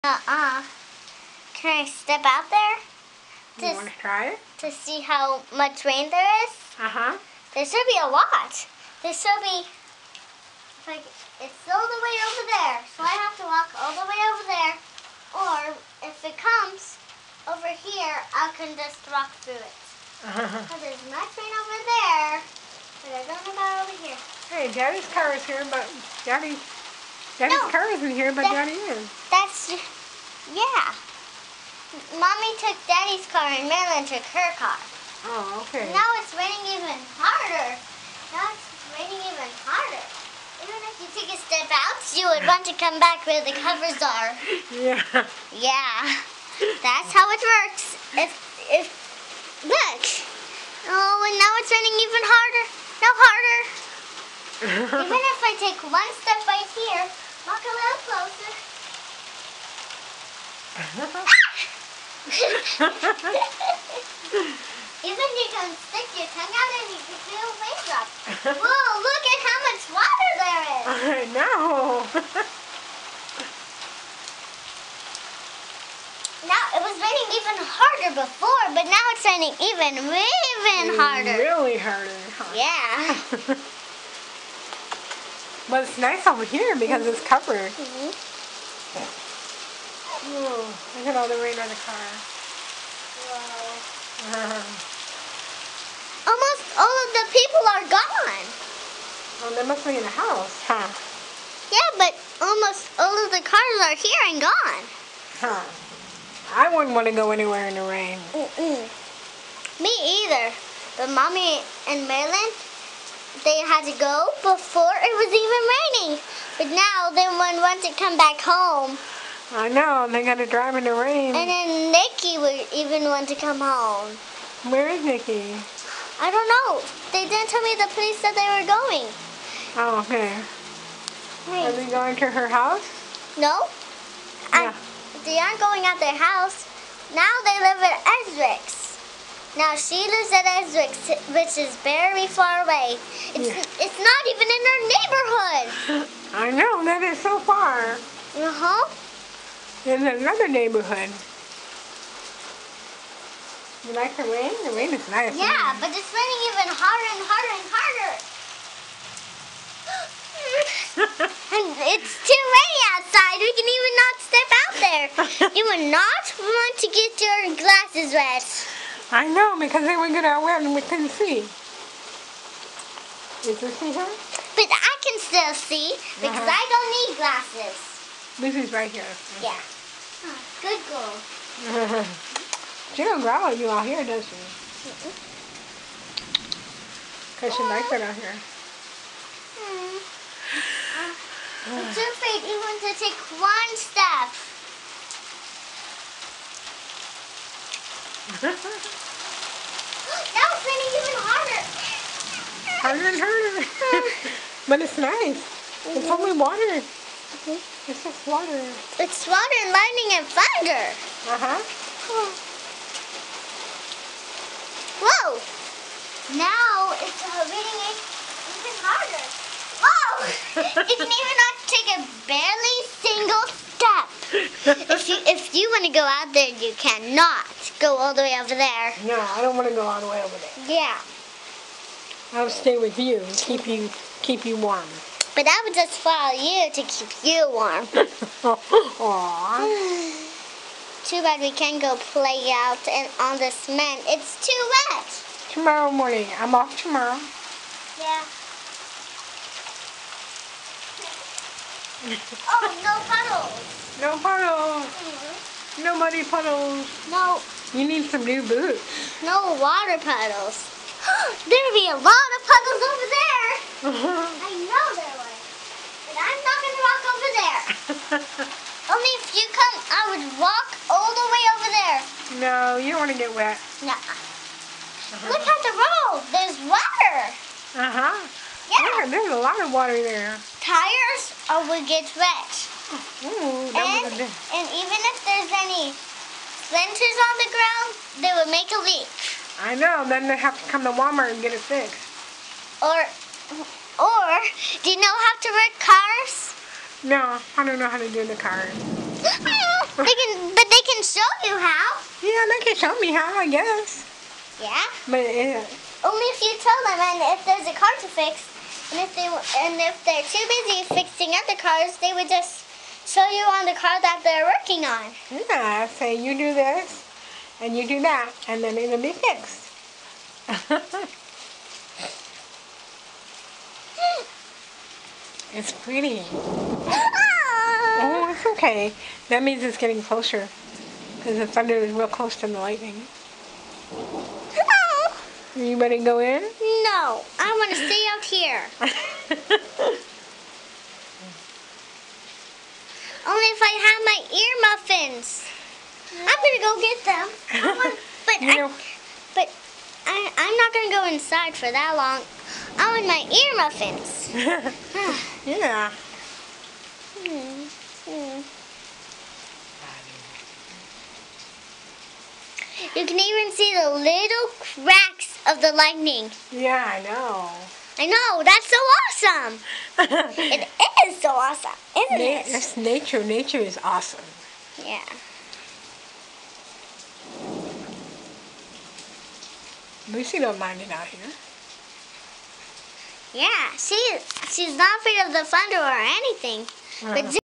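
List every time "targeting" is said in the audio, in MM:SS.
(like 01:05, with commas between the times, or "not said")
not said.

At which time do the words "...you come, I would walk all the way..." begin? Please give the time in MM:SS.
04:29.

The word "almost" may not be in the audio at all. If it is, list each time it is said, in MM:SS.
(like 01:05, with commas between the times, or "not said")
01:36, 01:42.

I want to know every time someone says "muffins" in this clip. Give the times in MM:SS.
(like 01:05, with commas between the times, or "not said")
05:45, 05:53.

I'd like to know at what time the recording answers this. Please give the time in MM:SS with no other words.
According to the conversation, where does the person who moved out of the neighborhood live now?
02:20.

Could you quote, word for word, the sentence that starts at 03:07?
Because she likes it out here.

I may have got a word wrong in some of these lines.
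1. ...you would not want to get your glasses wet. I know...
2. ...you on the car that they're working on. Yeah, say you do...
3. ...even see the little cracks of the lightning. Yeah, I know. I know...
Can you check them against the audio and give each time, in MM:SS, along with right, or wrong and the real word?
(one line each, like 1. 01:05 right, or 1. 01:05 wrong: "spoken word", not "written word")
1. 02:45 right
2. 05:13 right
3. 06:03 right.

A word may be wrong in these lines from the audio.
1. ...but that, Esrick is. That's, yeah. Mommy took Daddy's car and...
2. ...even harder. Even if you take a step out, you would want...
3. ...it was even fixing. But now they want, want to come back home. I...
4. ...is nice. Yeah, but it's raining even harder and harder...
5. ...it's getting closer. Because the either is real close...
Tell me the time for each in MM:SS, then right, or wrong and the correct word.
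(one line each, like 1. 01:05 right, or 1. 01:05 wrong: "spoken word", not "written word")
1. 00:28 wrong: "Daddy", not "Esrick"
2. 00:39 right
3. 01:55 wrong: "raining", not "fixing"
4. 02:34 right
5. 05:29 wrong: "thunder", not "either".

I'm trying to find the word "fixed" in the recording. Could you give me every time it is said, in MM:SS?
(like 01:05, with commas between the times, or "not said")
04:51, 05:19.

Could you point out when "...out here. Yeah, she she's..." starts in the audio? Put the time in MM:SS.
06:20.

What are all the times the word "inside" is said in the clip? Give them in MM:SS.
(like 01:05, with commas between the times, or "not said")
05:51.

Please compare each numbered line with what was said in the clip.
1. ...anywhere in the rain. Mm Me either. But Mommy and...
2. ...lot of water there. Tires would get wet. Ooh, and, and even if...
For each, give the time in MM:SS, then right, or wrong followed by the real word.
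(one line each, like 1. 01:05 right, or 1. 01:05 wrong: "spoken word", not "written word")
1. 01:47 right
2. 04:39 right.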